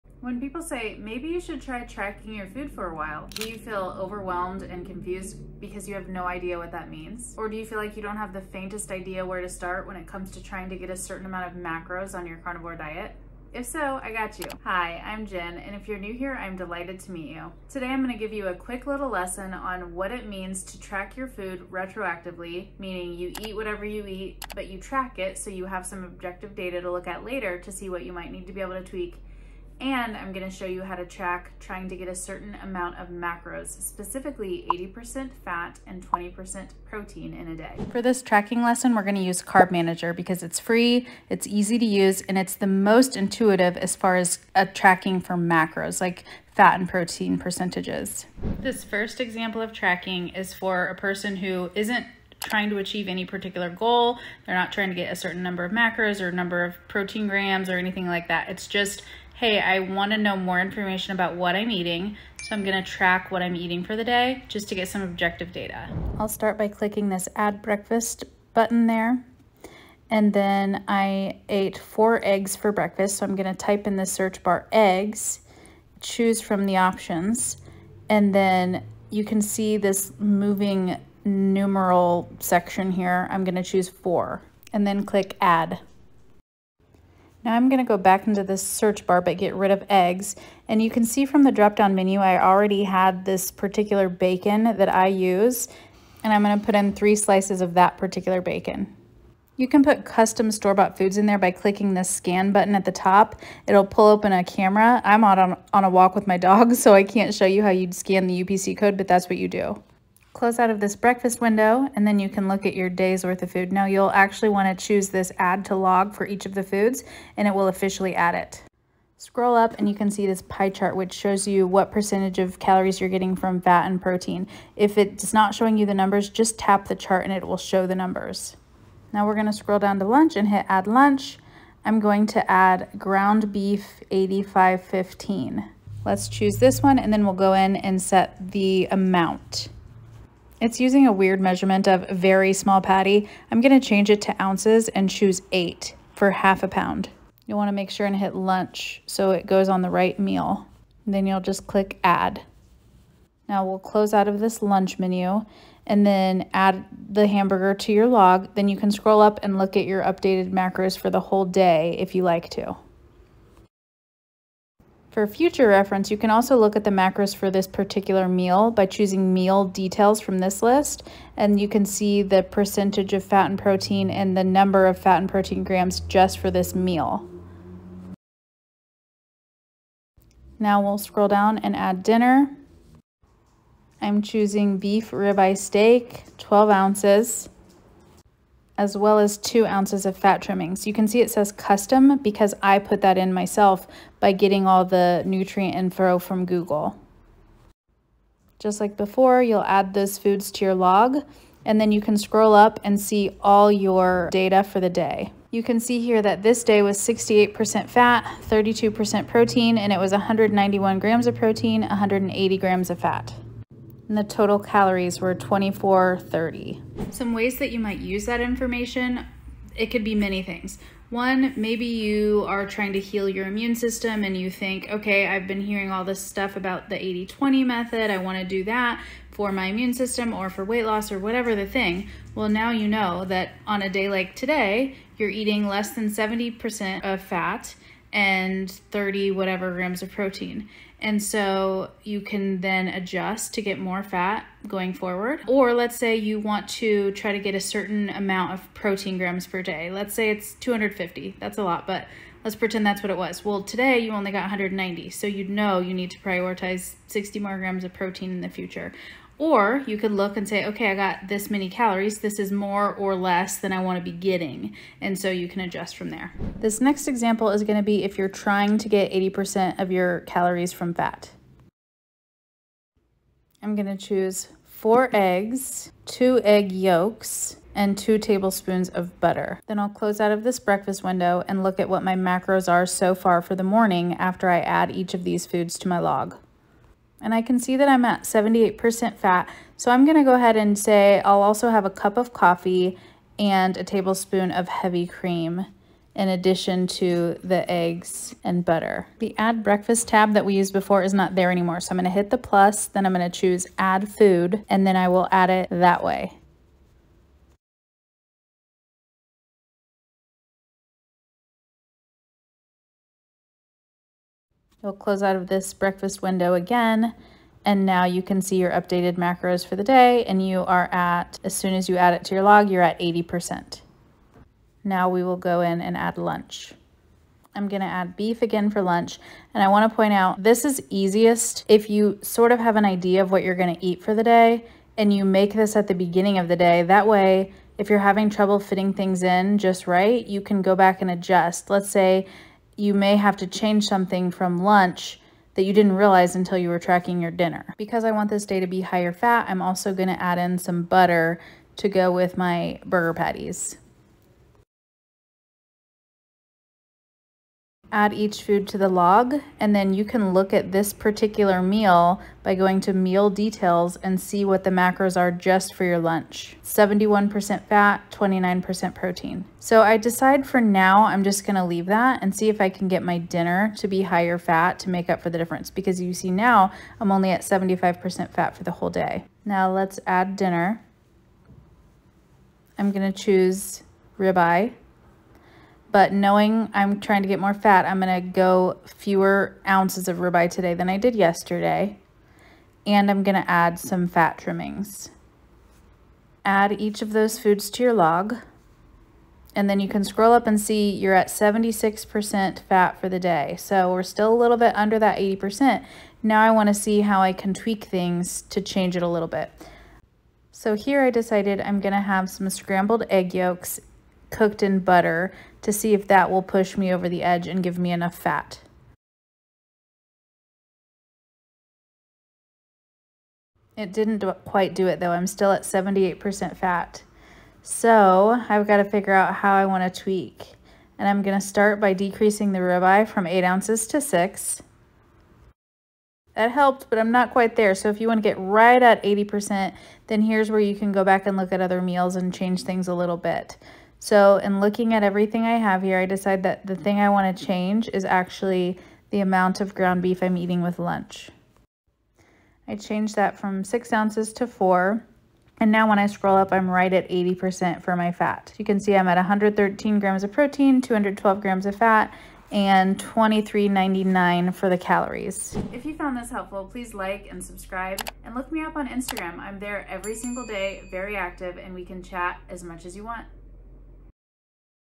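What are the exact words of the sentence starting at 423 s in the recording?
It didn't do quite do it though.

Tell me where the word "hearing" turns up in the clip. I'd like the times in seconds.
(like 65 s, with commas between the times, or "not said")
225 s.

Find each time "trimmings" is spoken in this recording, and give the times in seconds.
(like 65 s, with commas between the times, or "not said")
190 s, 394 s.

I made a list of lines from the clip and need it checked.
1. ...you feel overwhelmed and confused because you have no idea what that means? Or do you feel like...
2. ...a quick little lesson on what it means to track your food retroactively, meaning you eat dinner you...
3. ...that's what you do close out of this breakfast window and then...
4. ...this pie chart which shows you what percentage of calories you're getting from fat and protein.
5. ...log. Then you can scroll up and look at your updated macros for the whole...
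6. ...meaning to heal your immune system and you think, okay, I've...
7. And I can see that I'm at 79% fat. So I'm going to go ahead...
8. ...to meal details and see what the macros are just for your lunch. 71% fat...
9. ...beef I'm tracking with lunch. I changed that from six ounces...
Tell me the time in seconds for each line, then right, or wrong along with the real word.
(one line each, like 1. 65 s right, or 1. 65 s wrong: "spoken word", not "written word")
1. 3 s right
2. 18 s wrong: "whatever", not "dinner"
3. 109 s right
4. 120 s right
5. 158 s right
6. 222 s wrong: "trying", not "meaning"
7. 287 s wrong: "78", not "79"
8. 362 s right
9. 450 s wrong: "eating", not "tracking".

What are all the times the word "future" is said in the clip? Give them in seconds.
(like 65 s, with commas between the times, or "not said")
165 s, 258 s.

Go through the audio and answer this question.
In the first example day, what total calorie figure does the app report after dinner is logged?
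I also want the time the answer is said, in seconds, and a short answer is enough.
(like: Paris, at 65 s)
2430, at 215 s.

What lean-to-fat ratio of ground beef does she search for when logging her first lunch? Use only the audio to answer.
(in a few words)
85/15.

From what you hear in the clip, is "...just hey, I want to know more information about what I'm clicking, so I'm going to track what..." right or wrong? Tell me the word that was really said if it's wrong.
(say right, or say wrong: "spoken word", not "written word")
wrong: "eating", not "clicking".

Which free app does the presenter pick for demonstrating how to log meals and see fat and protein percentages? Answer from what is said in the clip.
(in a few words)
Carb Manager.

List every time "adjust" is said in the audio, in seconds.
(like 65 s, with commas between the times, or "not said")
242 s, 265 s, 341 s.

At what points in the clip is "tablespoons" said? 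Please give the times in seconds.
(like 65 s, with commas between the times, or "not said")
278 s, 293 s.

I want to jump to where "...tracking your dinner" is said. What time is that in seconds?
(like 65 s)
346 s.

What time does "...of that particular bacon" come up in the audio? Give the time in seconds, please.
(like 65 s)
97 s.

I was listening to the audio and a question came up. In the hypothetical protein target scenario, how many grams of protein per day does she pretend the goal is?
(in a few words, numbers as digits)
250.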